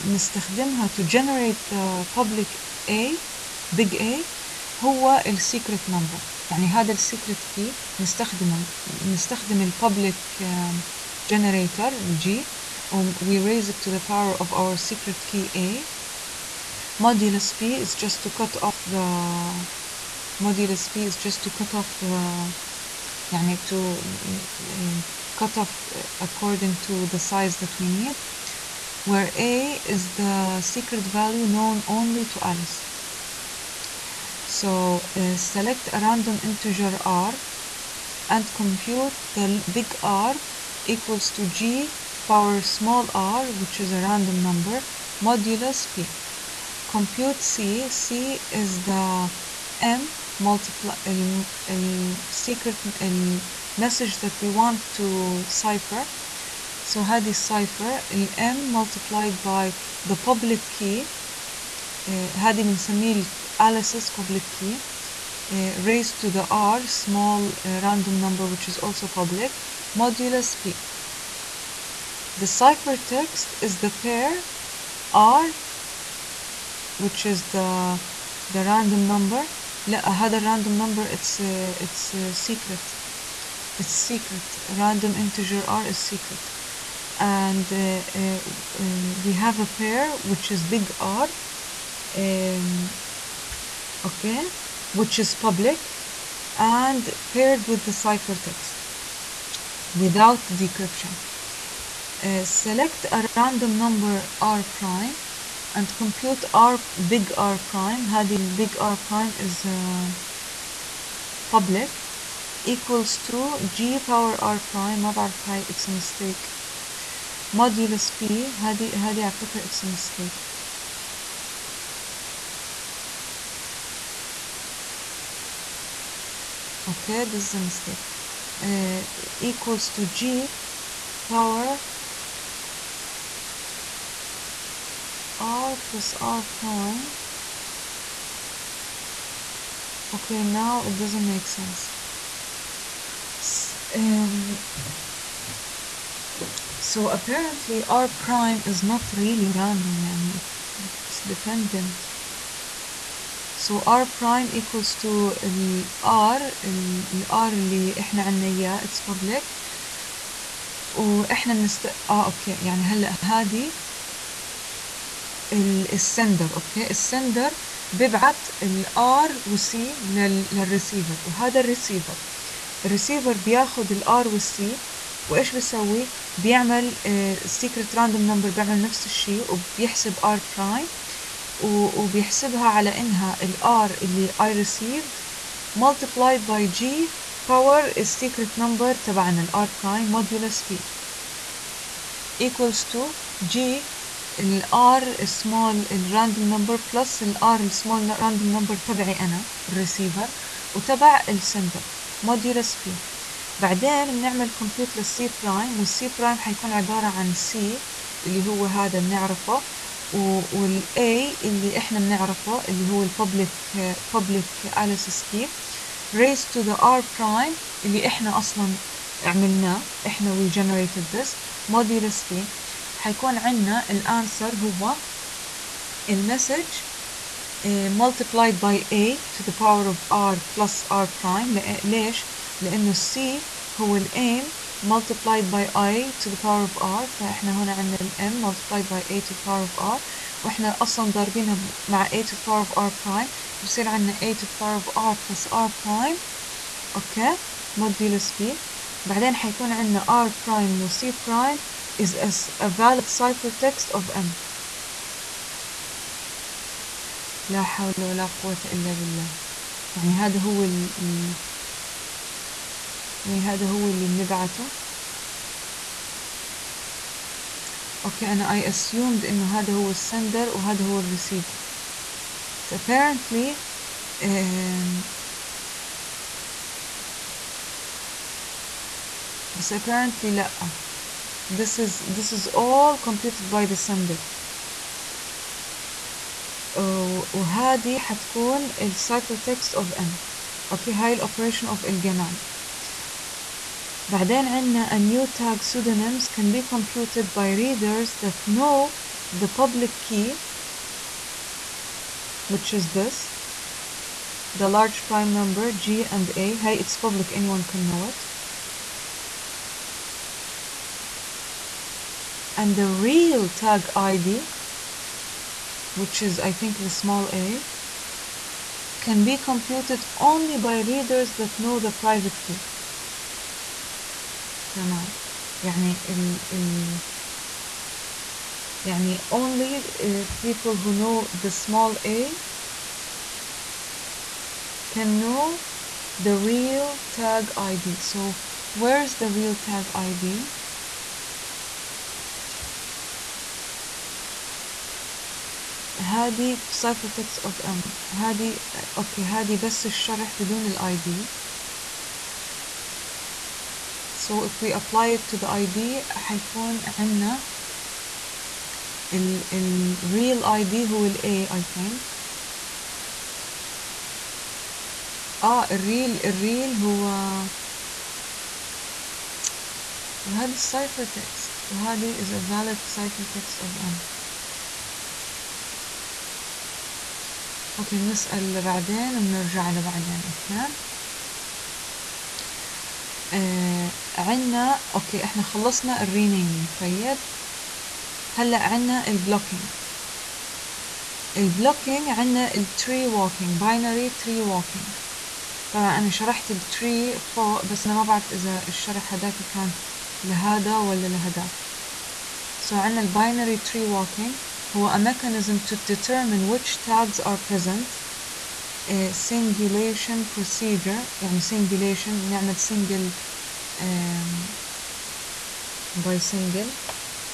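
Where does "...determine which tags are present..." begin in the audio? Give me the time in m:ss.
6:45.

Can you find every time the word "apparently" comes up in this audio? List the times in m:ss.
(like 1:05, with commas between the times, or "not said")
2:27, 4:32, 4:39.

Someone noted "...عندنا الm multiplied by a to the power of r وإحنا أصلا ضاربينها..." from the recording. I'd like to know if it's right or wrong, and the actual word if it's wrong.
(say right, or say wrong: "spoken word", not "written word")
right.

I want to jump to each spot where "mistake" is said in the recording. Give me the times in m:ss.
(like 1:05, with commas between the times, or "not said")
1:55, 1:59, 2:07.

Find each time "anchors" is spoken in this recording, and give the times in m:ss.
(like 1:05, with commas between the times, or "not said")
not said.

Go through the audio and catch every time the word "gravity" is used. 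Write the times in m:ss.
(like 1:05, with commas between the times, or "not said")
not said.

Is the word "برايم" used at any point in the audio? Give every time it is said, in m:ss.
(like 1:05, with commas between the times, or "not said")
3:00, 3:09.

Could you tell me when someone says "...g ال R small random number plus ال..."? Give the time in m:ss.
3:13.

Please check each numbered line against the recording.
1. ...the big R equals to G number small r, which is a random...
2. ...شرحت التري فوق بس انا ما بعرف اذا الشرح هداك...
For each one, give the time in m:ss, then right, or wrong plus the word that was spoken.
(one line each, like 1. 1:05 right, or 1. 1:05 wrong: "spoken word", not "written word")
1. 0:39 wrong: "power", not "number"
2. 6:36 right.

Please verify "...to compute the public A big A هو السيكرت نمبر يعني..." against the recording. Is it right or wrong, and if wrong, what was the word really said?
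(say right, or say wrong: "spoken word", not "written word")
wrong: "generate", not "compute".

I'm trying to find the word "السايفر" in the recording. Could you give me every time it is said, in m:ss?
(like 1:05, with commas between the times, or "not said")
4:48, 6:10.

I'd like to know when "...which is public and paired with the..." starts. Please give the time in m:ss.
1:34.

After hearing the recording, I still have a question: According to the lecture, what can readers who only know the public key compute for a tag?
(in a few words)
New tag pseudonyms.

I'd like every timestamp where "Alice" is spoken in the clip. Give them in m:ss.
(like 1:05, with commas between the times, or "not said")
0:32, 1:03, 3:34.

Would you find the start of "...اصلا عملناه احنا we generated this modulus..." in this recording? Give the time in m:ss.
3:38.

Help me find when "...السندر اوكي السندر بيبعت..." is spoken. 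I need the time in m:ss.
2:45.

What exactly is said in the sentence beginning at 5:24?
تمام يعني ال ال يعني only uh, people who know the small a can know the real tag ID.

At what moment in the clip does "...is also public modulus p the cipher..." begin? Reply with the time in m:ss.
1:08.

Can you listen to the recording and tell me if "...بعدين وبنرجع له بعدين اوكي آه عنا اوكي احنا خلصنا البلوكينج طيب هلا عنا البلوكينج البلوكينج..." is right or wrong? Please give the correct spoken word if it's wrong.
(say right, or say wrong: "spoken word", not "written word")
wrong: "الرينيمينج", not "البلوكينج".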